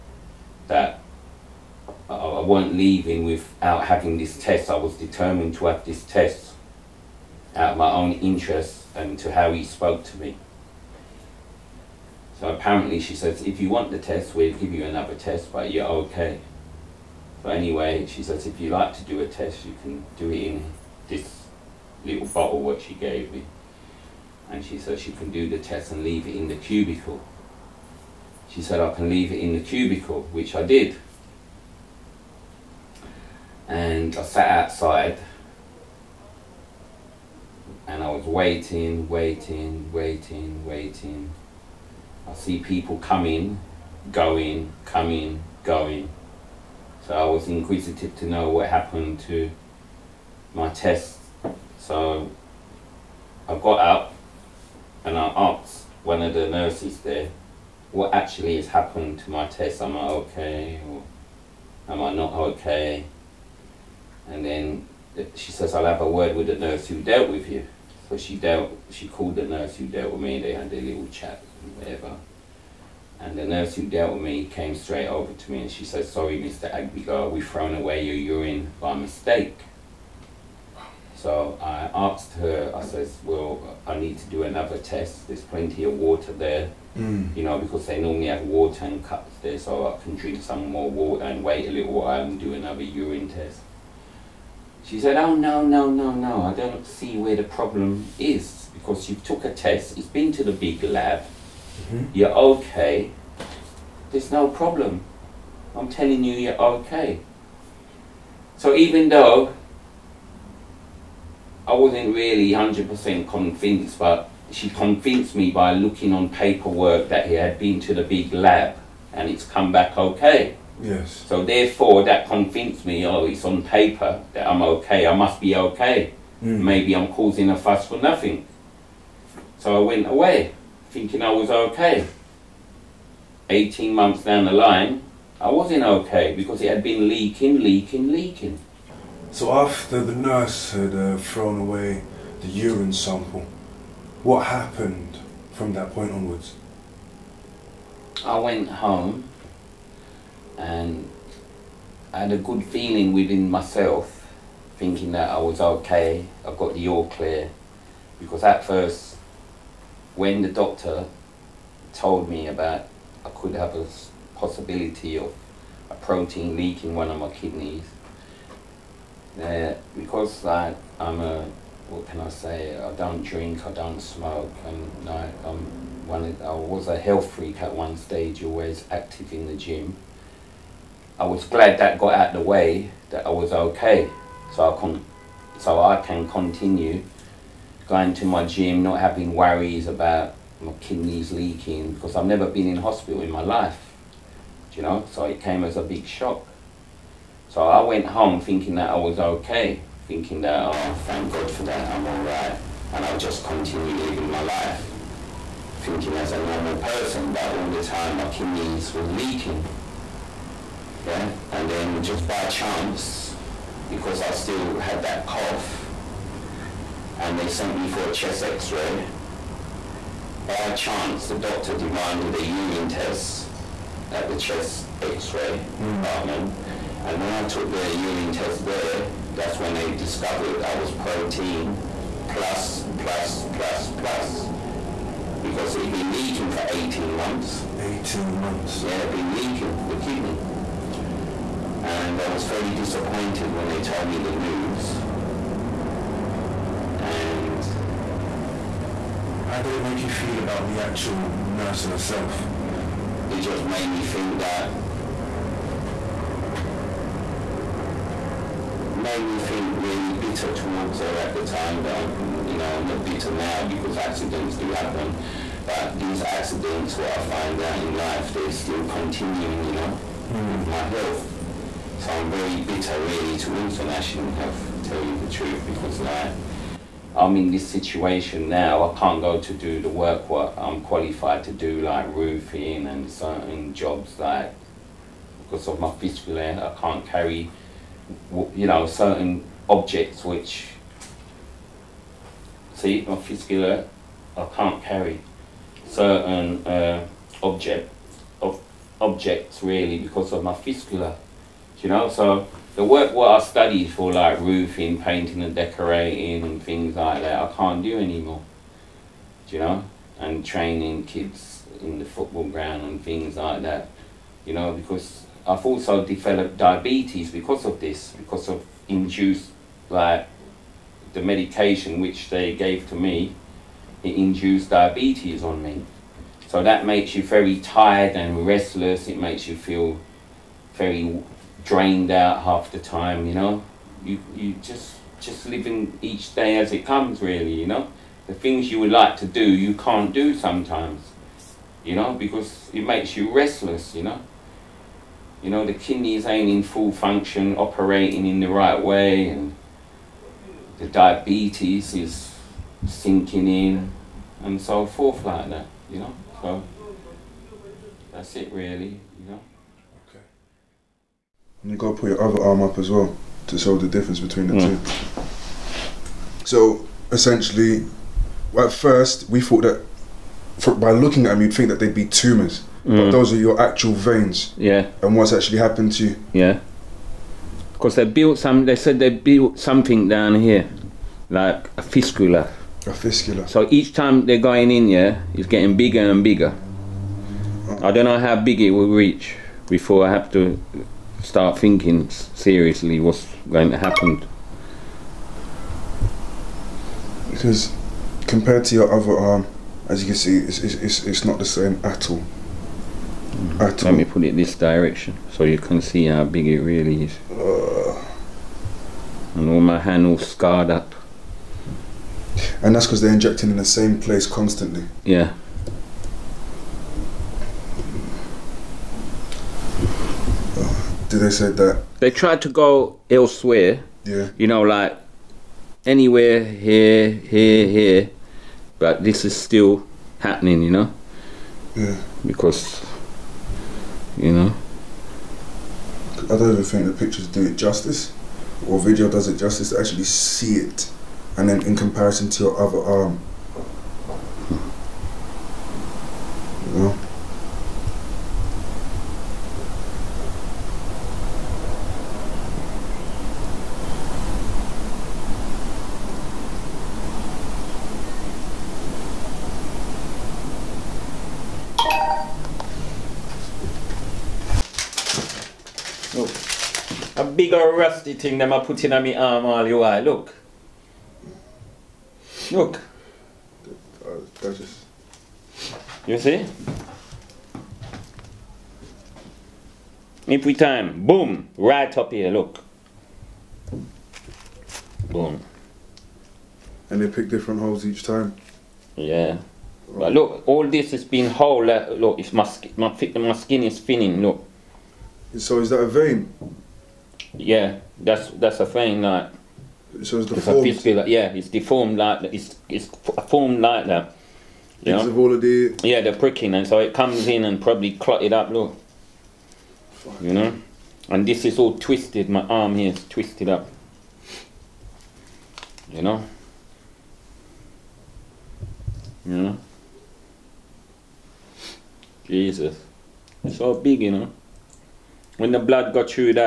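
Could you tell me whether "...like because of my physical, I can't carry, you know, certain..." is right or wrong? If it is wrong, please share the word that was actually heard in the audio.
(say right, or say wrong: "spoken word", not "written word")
right.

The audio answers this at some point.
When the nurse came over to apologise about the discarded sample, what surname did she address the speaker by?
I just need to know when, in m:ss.
1:16.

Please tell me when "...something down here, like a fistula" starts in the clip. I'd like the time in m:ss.
6:19.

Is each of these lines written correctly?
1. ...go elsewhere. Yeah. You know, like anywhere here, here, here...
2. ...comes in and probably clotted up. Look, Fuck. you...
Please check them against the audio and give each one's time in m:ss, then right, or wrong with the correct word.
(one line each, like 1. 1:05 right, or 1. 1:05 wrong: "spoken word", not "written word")
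1. 7:02 right
2. 8:26 right.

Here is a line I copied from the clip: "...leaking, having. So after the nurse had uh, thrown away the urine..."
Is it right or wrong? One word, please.
wrong.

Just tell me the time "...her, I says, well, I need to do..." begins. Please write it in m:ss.
1:22.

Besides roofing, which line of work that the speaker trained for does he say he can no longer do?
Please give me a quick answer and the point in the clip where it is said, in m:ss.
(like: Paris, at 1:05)
painting and decorating, at 5:05.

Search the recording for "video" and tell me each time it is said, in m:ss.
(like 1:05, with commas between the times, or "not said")
7:18.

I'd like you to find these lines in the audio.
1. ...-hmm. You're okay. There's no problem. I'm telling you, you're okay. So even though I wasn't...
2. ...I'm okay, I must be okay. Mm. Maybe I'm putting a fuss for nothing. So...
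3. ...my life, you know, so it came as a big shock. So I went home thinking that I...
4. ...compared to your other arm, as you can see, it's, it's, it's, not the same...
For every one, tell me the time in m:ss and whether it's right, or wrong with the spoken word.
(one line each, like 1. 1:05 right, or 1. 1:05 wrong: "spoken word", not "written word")
1. 1:41 right
2. 2:04 wrong: "causing", not "putting"
3. 3:13 right
4. 6:38 right.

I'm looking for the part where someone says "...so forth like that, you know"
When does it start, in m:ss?
5:54.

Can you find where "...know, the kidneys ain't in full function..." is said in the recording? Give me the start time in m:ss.
5:45.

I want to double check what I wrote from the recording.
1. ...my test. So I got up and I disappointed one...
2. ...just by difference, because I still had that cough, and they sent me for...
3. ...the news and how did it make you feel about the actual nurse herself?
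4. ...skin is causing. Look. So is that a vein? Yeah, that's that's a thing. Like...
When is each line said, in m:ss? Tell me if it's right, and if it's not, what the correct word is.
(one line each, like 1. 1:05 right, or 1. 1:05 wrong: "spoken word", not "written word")
1. 0:50 wrong: "asked", not "disappointed"
2. 3:32 wrong: "chance", not "difference"
3. 4:04 right
4. 8:13 wrong: "thinning", not "causing".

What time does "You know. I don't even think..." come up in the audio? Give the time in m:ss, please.
7:14.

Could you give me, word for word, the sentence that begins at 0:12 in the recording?
So apparently she says, if you want the test, we'll give you another test, but you're okay.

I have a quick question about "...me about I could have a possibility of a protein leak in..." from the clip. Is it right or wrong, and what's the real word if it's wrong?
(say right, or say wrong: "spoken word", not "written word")
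right.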